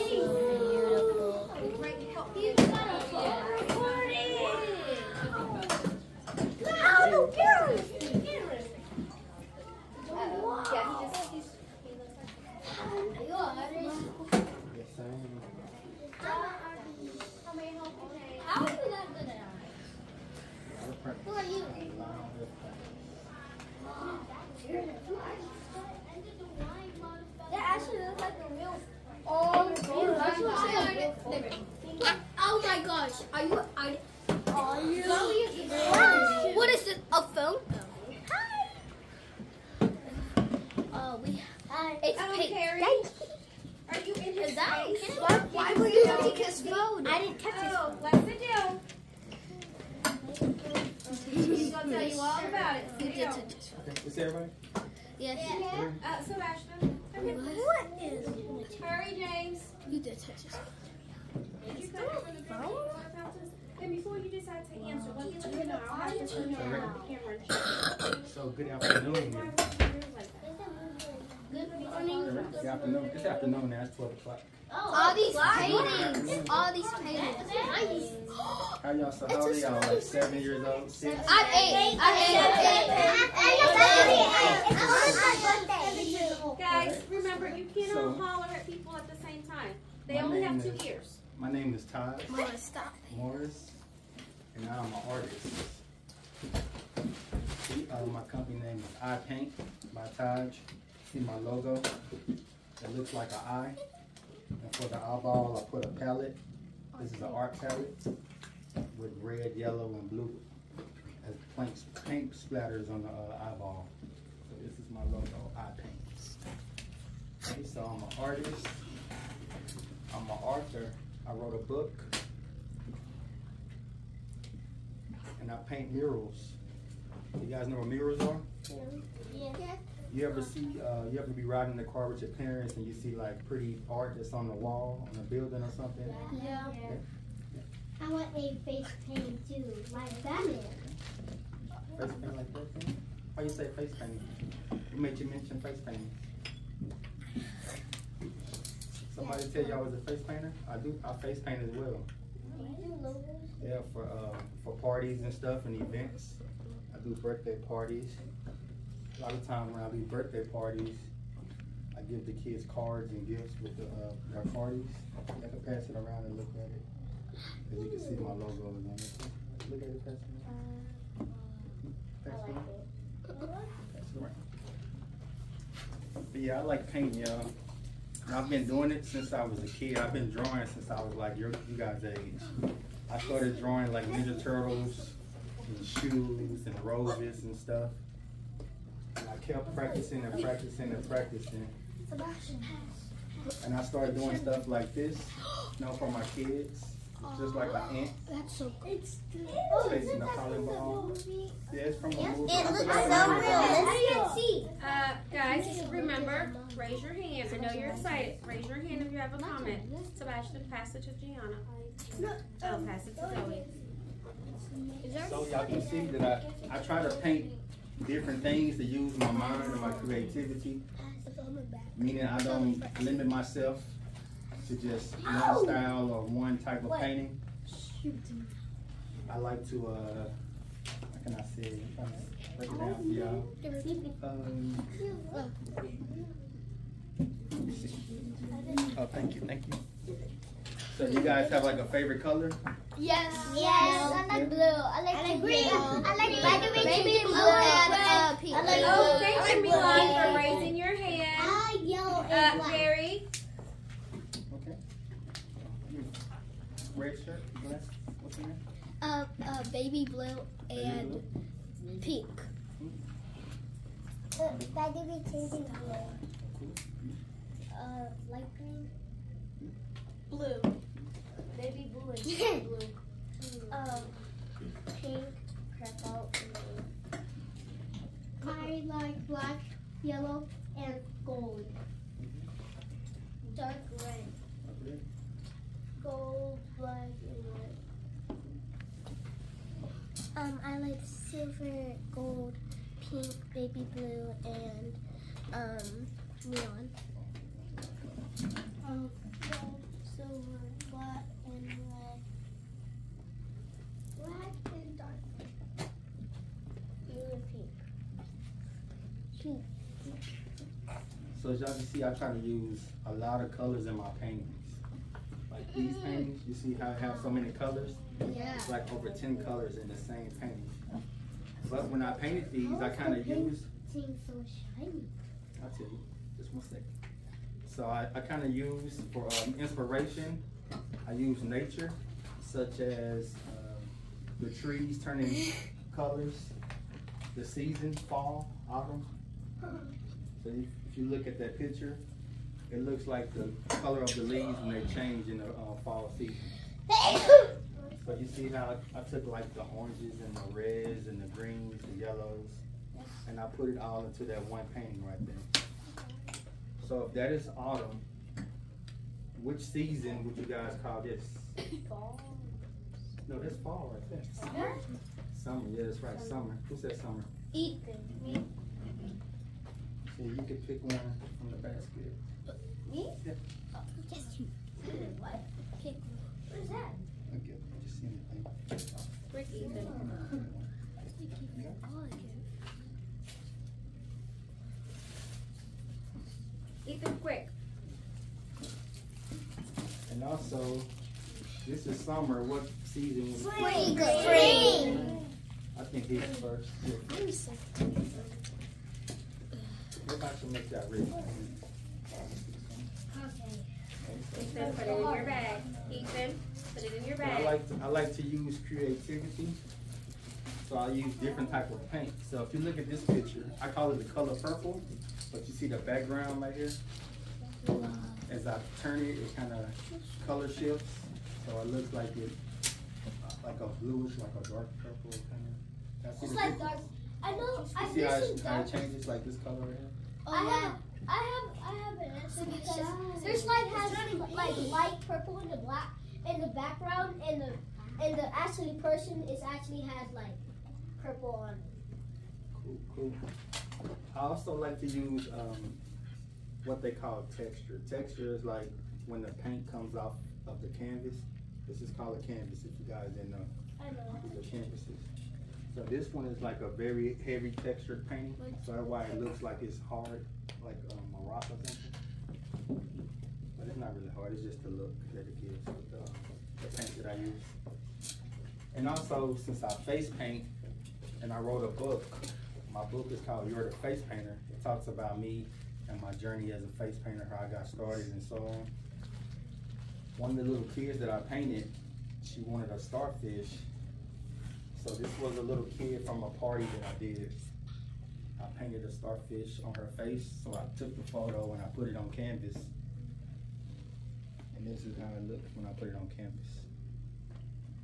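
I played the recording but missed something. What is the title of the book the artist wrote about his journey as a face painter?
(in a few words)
You're the Face Painter.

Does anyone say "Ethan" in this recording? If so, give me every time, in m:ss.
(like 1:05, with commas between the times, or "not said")
6:07, 6:19, 6:26.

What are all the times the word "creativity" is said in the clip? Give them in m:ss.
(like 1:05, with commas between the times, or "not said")
3:39, 6:48.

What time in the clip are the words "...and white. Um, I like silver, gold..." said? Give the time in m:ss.
4:47.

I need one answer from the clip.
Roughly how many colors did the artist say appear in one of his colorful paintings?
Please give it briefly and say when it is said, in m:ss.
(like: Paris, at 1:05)
Over 10, at 5:18.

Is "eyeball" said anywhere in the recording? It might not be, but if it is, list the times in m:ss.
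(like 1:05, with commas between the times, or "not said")
1:44, 1:53.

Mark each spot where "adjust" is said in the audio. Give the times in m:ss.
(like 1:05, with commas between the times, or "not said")
not said.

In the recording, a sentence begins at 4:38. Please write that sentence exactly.
I like black, yellow, and gold.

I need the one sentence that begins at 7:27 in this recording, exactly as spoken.
Texture is like when the paint comes off of the canvas.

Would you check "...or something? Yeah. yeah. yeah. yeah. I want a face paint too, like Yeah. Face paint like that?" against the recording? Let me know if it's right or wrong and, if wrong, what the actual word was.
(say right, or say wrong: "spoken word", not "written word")
wrong: "Batman", not "Yeah".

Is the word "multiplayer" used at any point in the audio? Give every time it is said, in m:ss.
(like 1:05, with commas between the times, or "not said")
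not said.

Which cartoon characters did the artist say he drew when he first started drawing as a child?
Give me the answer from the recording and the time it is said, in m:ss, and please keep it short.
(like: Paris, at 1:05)
Ninja Turtles, at 3:04.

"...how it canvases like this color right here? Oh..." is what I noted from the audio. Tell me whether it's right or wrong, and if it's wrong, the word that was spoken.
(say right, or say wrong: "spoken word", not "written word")
wrong: "changes", not "canvases".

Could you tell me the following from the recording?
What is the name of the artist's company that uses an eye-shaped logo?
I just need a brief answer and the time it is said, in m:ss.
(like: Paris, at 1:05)
I Paint by Taj, at 1:39.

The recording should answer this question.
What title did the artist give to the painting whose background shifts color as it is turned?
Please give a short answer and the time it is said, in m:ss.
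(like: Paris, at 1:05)
The Color Purple, at 6:53.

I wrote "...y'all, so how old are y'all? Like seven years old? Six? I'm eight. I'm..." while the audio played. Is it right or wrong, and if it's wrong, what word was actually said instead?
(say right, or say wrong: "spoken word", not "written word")
right.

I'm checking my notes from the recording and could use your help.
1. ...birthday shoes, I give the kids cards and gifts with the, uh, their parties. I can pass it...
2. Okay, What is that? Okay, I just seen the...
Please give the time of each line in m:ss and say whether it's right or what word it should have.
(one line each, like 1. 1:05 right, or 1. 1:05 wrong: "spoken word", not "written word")
1. 2:39 wrong: "parties", not "shoes"
2. 6:15 right.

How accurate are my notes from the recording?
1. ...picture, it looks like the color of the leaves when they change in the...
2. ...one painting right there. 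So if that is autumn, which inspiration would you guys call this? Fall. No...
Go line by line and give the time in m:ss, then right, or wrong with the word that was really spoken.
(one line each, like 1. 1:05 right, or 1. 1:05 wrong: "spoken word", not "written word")
1. 5:41 right
2. 5:54 wrong: "season", not "inspiration".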